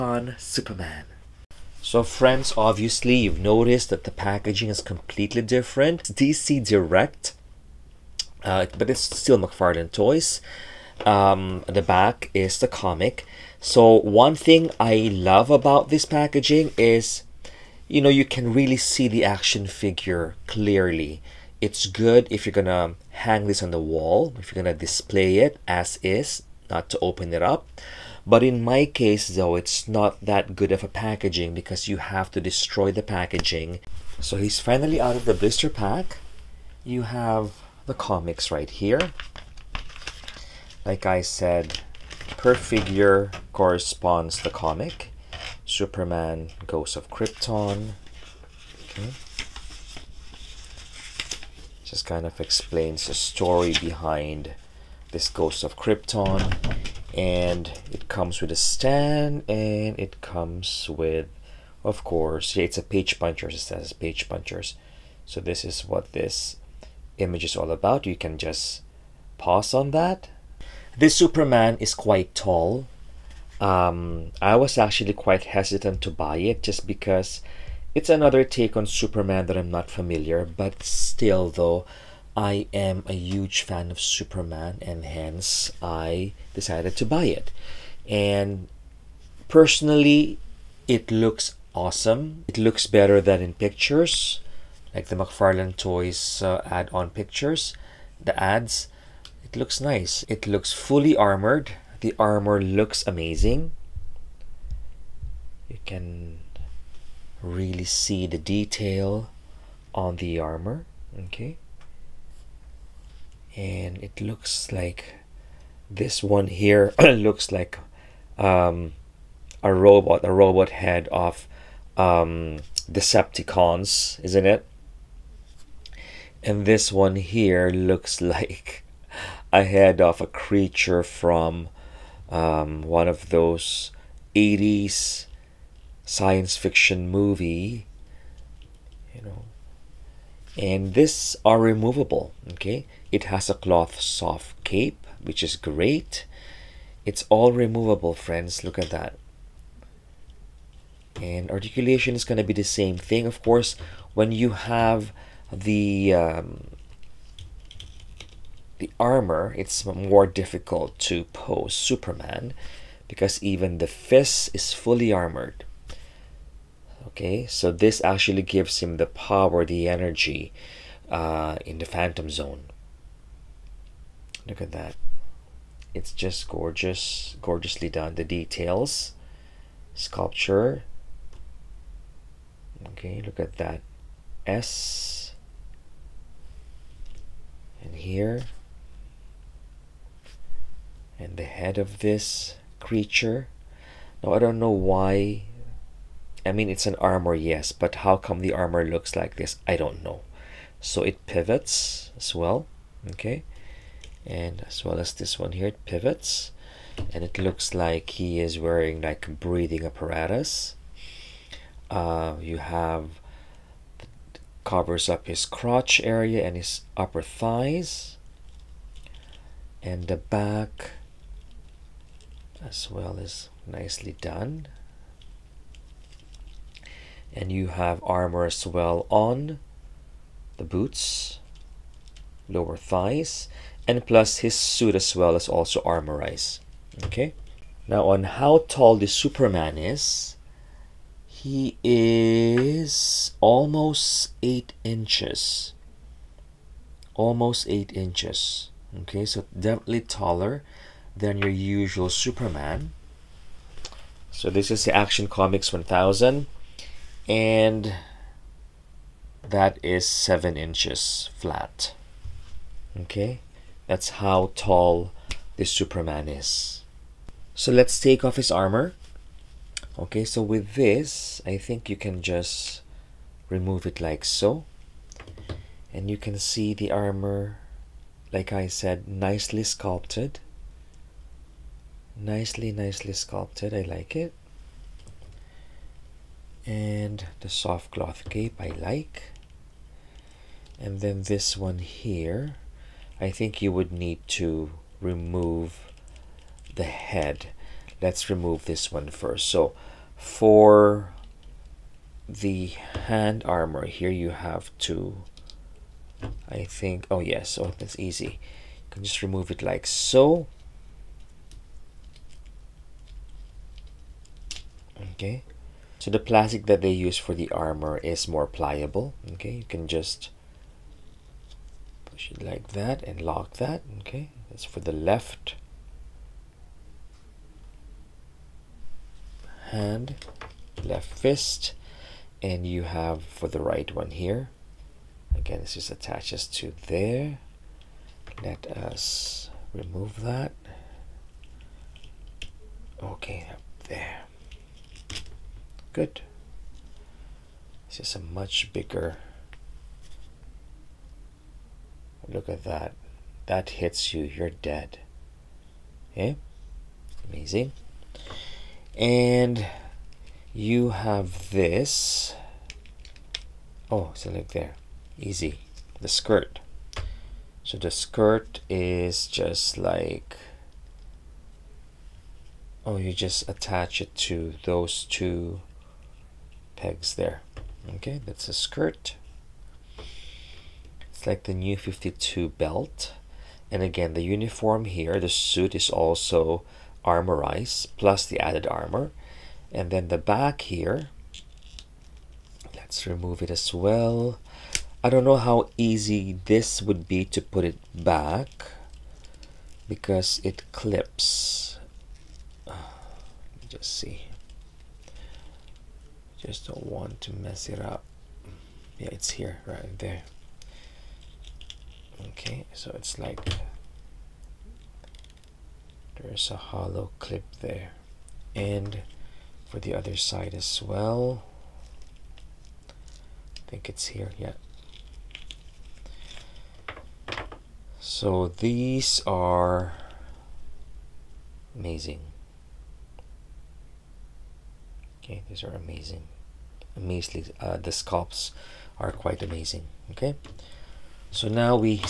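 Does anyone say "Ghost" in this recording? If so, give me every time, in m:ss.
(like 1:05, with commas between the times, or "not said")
0:46, 0:55.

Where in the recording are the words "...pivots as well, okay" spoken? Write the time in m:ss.
3:21.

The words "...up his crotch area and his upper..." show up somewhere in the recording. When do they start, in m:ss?
3:35.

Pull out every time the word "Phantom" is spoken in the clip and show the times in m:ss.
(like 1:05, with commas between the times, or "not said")
2:51.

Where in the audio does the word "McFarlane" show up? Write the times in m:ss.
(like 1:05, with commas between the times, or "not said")
0:09, 1:35.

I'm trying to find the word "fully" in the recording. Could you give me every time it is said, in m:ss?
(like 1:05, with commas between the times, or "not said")
1:40, 2:44.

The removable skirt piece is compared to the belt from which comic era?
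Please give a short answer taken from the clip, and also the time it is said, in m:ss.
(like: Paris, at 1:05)
New 52, at 6:21.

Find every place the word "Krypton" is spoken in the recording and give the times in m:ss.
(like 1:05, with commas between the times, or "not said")
0:47, 0:55.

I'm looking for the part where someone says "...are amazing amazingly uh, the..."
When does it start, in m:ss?
7:15.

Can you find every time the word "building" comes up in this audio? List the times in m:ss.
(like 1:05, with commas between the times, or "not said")
not said.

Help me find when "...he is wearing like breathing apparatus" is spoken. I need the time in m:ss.
3:28.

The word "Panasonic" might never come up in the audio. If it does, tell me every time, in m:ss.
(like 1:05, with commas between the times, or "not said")
not said.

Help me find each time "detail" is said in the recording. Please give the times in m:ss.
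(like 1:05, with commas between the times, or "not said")
1:48, 2:58.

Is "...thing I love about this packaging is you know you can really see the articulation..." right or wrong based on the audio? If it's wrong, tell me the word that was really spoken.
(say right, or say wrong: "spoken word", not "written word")
wrong: "action", not "articulation".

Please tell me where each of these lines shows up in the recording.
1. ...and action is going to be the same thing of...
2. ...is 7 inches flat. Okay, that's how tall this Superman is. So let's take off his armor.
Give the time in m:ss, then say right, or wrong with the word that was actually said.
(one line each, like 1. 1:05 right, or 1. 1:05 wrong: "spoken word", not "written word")
1. 2:31 wrong: "articulation", not "action"
2. 4:19 right.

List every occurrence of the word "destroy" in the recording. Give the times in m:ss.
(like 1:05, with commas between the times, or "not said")
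0:32.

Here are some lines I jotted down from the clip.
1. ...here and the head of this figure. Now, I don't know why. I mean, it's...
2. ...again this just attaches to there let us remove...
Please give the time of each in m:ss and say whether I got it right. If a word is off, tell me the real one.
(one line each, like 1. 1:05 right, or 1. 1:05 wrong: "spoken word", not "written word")
1. 3:07 wrong: "creature", not "figure"
2. 5:35 right.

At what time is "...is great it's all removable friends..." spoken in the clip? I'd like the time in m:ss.
2:25.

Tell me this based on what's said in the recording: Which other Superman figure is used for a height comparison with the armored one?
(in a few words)
Action Comics 1000.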